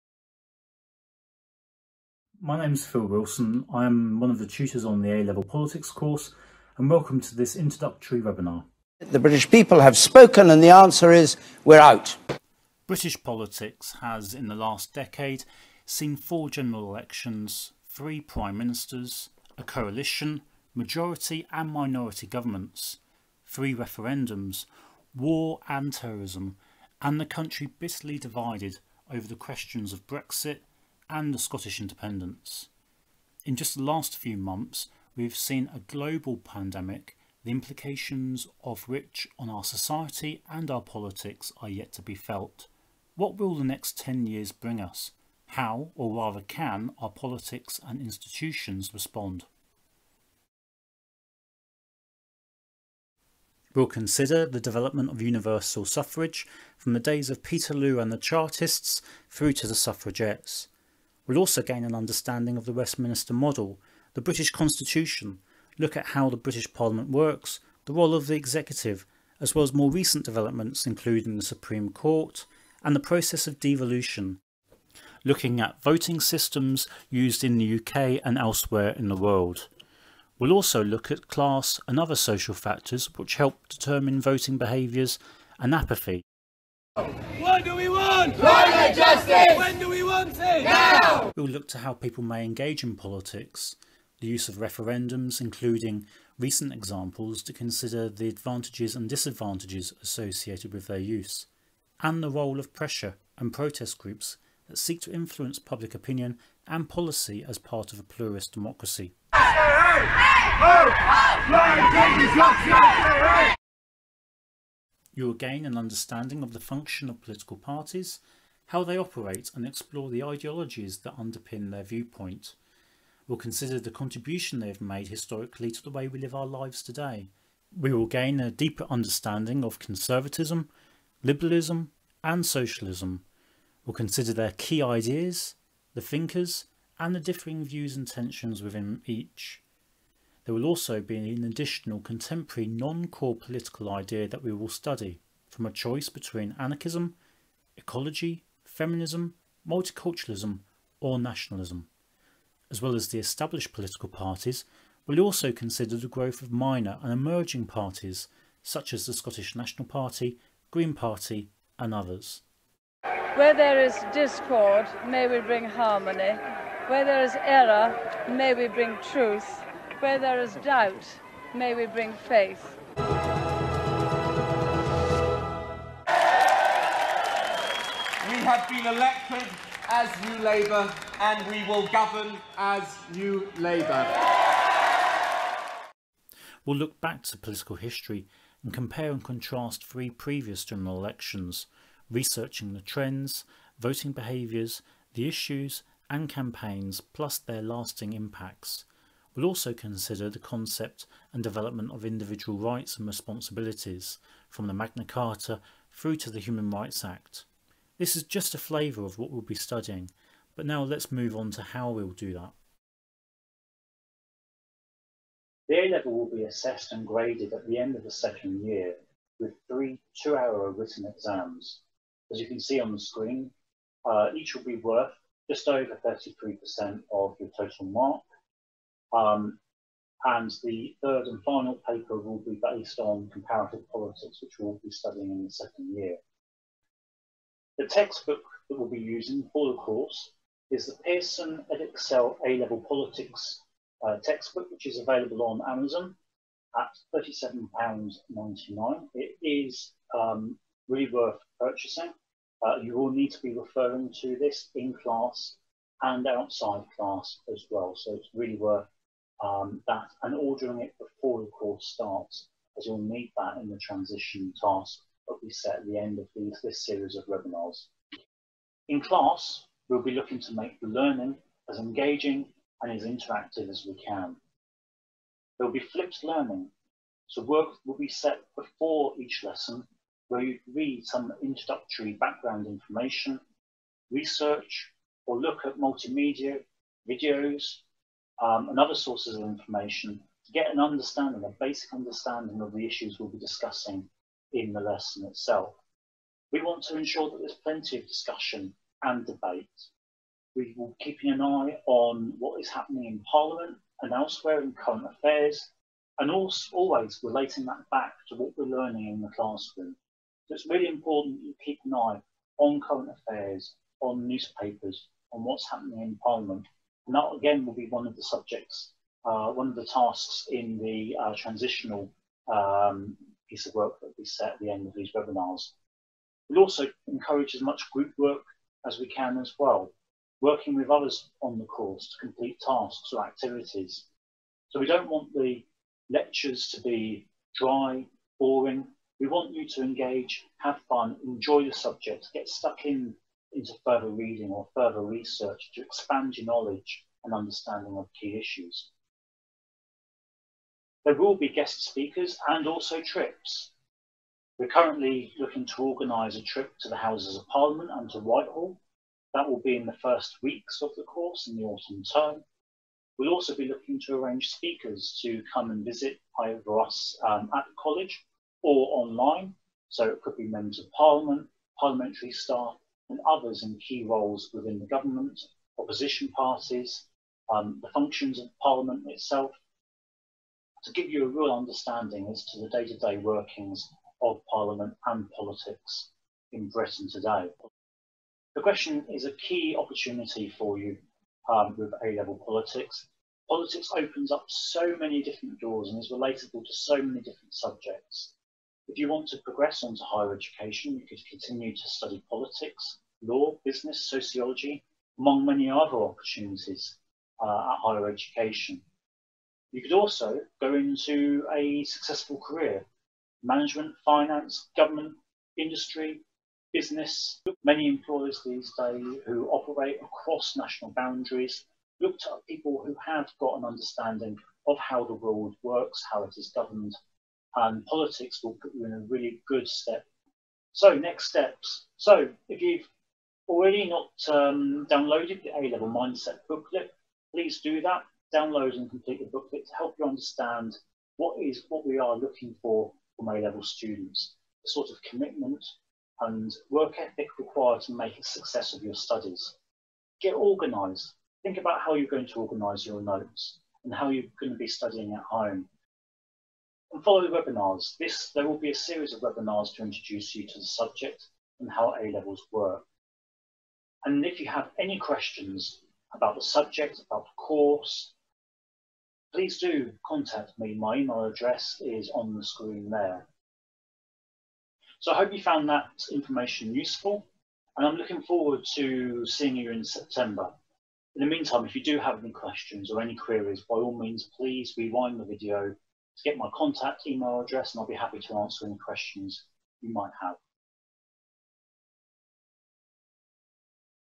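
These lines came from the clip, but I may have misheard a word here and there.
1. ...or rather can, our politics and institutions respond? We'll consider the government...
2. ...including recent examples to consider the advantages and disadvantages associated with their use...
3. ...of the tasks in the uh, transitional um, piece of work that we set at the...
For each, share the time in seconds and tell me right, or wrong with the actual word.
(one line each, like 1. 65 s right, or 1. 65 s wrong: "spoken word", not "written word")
1. 45 s wrong: "development", not "government"
2. 95 s right
3. 319 s right.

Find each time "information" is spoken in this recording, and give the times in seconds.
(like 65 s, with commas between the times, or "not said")
282 s, 289 s, 476 s.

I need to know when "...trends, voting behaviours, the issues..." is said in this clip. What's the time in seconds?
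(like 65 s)
192 s.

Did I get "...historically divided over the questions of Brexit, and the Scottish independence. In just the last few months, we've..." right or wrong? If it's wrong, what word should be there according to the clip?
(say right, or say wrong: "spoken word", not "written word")
wrong: "bitterly", not "historically".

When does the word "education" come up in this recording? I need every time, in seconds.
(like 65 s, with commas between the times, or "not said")
400 s, 408 s.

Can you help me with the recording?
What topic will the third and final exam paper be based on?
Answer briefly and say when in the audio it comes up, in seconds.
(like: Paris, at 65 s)
Comparative politics, at 233 s.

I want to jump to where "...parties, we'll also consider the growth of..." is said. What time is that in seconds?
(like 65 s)
154 s.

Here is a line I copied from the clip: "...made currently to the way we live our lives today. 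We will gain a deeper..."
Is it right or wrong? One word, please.
wrong.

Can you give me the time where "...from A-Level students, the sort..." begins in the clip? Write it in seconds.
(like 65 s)
443 s.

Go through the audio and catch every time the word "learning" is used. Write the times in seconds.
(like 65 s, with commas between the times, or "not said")
270 s, 276 s, 308 s.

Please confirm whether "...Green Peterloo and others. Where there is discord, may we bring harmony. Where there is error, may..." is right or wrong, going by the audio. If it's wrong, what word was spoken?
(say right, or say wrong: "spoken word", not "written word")
wrong: "Party", not "Peterloo".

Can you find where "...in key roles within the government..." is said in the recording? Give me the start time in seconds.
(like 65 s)
373 s.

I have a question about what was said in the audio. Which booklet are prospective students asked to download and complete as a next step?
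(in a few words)
A-Level Mindset booklet.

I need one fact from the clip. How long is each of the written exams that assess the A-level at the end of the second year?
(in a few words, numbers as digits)
2 hours.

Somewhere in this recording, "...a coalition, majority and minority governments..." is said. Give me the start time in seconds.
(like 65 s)
19 s.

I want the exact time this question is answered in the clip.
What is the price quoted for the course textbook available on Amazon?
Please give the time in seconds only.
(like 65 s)
247 s.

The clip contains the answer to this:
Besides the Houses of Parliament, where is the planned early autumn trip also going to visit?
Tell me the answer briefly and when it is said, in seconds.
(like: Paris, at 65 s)
Whitehall, at 358 s.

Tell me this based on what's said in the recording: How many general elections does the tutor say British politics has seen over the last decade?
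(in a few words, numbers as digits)
4.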